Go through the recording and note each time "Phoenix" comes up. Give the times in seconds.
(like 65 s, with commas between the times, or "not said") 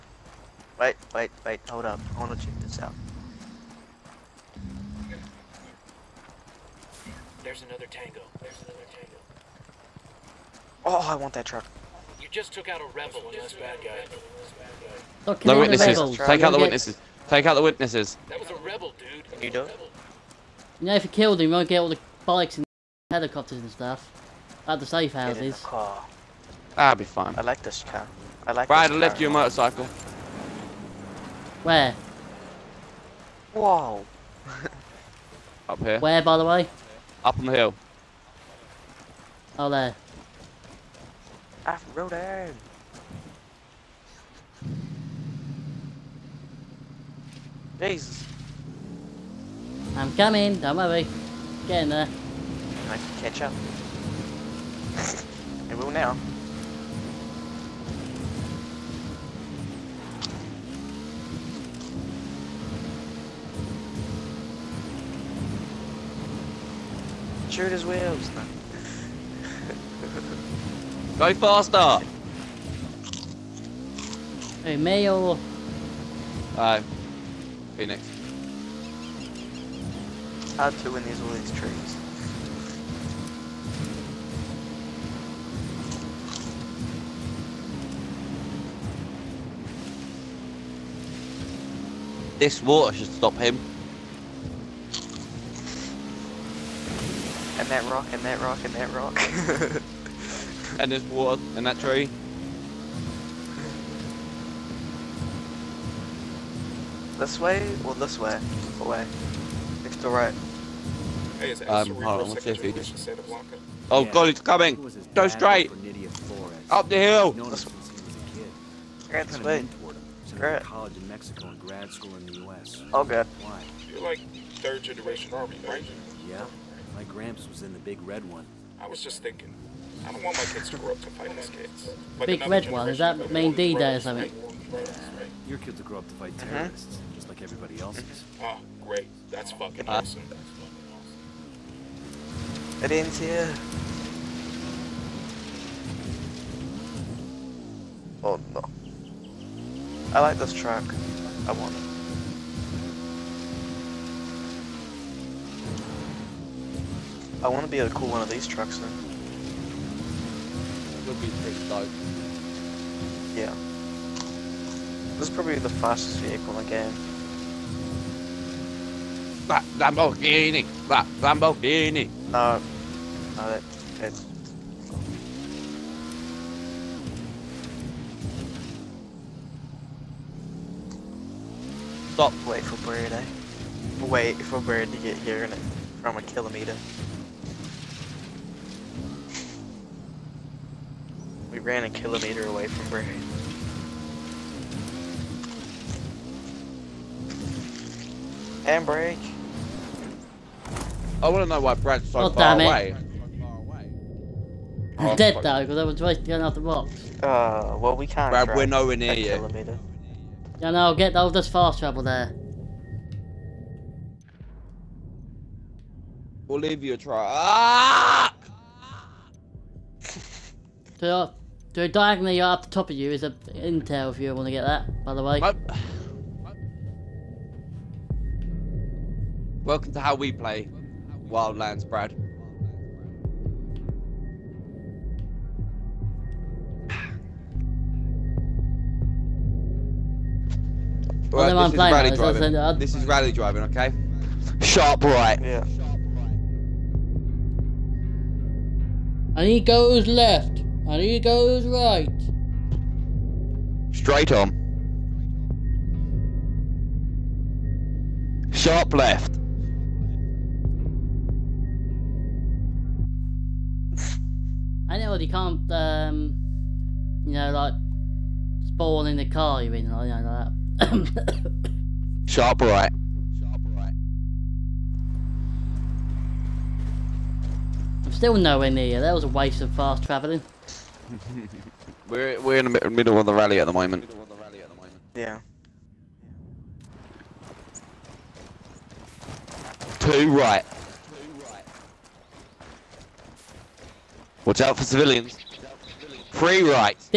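77 s.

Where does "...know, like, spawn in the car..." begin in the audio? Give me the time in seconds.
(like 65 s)
267 s.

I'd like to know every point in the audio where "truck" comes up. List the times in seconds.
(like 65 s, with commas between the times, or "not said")
11 s, 158 s.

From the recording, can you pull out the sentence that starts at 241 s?
Right, this, is rally now, driving.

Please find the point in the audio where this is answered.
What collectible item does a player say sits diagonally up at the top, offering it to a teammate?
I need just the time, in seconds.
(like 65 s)
223 s.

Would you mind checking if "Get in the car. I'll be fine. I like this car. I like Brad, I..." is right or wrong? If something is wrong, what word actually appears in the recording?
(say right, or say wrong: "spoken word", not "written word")
wrong: "Right", not "Brad".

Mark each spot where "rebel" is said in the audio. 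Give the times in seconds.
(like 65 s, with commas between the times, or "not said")
12 s, 18 s.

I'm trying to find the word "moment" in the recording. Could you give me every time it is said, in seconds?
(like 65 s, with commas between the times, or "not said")
283 s.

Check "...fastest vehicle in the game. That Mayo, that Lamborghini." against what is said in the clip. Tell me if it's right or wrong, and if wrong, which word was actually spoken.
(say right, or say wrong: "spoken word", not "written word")
wrong: "Lamborghini", not "Mayo".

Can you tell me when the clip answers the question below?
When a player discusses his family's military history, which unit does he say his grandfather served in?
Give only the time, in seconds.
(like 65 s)
127 s.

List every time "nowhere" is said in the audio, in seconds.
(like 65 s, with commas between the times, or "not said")
208 s, 278 s.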